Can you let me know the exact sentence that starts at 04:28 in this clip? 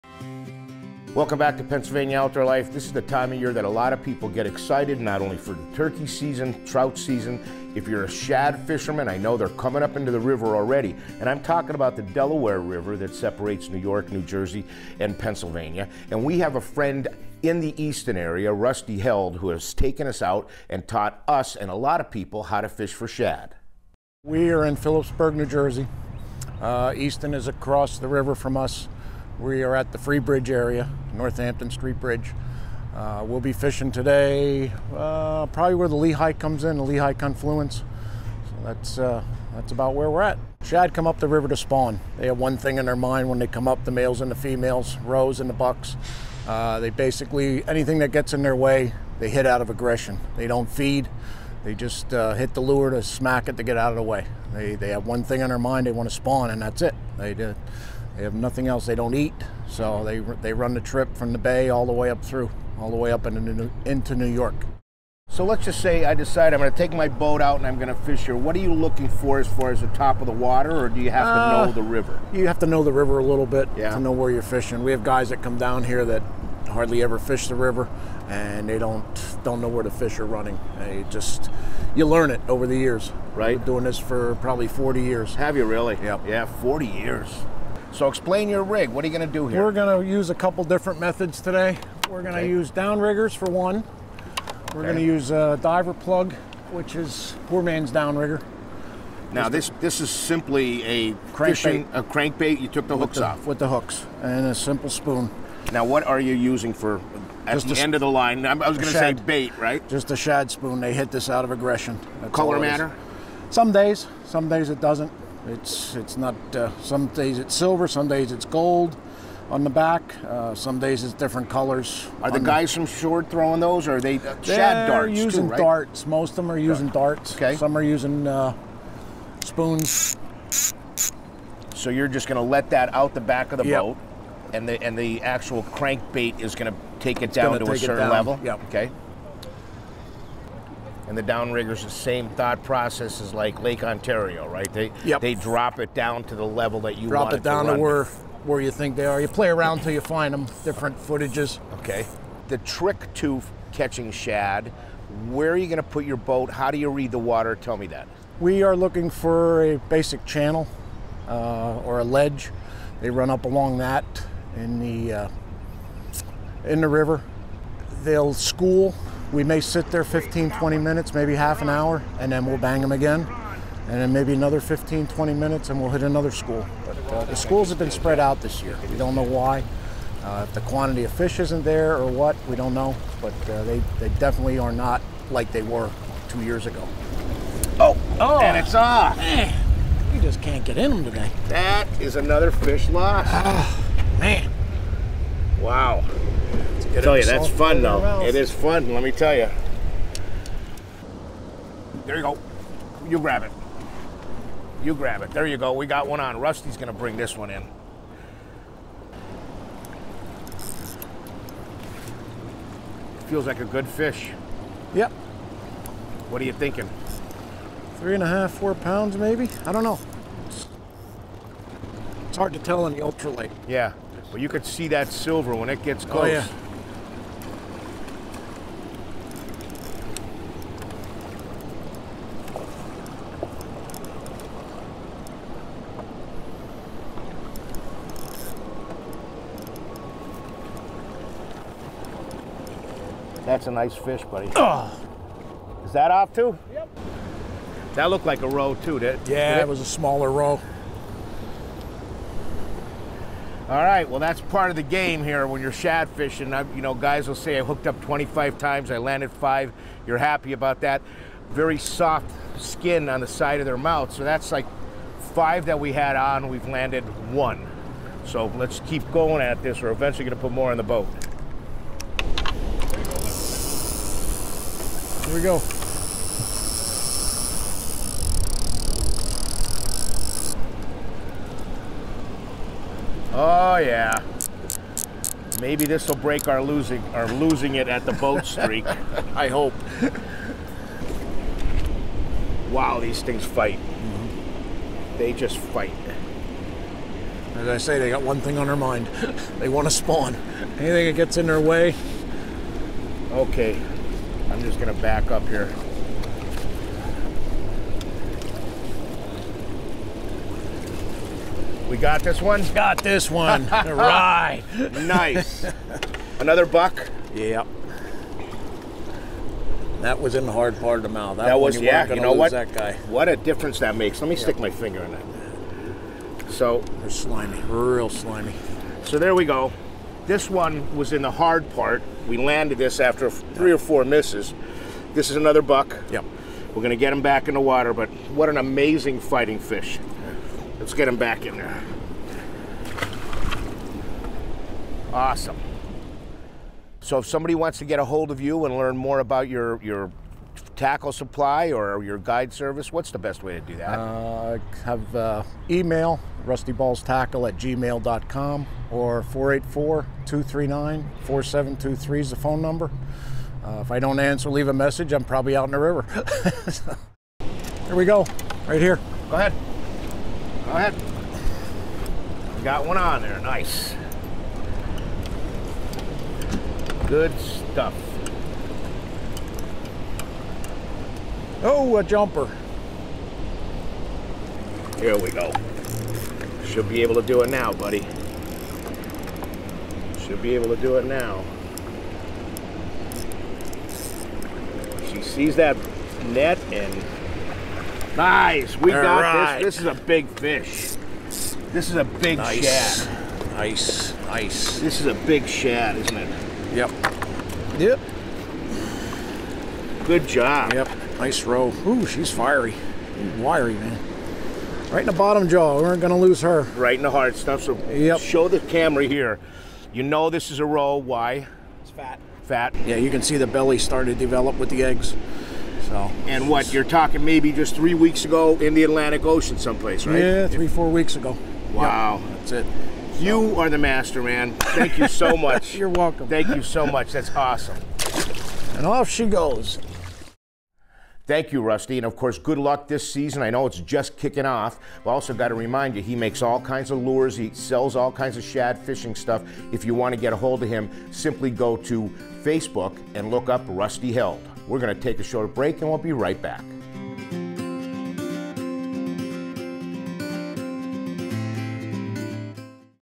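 So let's keep going at this.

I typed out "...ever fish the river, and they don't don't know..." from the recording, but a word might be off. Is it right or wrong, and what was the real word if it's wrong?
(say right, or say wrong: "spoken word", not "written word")
right.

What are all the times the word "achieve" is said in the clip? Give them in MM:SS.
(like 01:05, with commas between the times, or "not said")
not said.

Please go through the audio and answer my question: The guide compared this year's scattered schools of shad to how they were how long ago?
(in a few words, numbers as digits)
Two years ago.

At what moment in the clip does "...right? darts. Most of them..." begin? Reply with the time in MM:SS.
02:05.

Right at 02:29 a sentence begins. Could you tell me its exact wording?
You play around till you find them.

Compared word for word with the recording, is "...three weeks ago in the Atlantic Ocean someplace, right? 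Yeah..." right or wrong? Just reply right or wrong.
right.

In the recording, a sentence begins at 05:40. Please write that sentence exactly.
Let's get him back in there.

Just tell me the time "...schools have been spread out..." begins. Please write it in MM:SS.
02:57.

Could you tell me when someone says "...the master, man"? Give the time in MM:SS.
07:13.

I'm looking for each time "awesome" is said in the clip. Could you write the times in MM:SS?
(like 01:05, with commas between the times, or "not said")
05:45, 07:17.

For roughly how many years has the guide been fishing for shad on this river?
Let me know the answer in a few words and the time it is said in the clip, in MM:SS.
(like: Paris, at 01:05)
40 years, at 01:24.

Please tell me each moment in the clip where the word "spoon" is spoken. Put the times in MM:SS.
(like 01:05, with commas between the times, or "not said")
01:44, 01:50, 02:09.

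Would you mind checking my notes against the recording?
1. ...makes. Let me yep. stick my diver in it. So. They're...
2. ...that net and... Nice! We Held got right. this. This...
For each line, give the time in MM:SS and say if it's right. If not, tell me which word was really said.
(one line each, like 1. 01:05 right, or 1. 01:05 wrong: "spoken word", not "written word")
1. 05:23 wrong: "finger", not "diver"
2. 06:35 wrong: "All", not "Held".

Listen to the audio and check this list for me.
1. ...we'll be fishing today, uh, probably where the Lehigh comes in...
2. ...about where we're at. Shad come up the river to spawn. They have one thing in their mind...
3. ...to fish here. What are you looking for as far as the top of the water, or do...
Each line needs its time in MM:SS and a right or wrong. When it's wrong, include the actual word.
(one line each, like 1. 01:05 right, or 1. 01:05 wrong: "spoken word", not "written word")
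1. 00:33 right
2. 00:39 right
3. 01:07 right.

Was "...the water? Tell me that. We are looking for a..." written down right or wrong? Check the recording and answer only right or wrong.
right.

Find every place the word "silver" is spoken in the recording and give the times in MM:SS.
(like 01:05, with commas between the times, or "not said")
01:57, 03:45.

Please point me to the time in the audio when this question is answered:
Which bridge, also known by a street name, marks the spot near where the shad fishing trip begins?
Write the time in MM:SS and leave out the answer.
00:29.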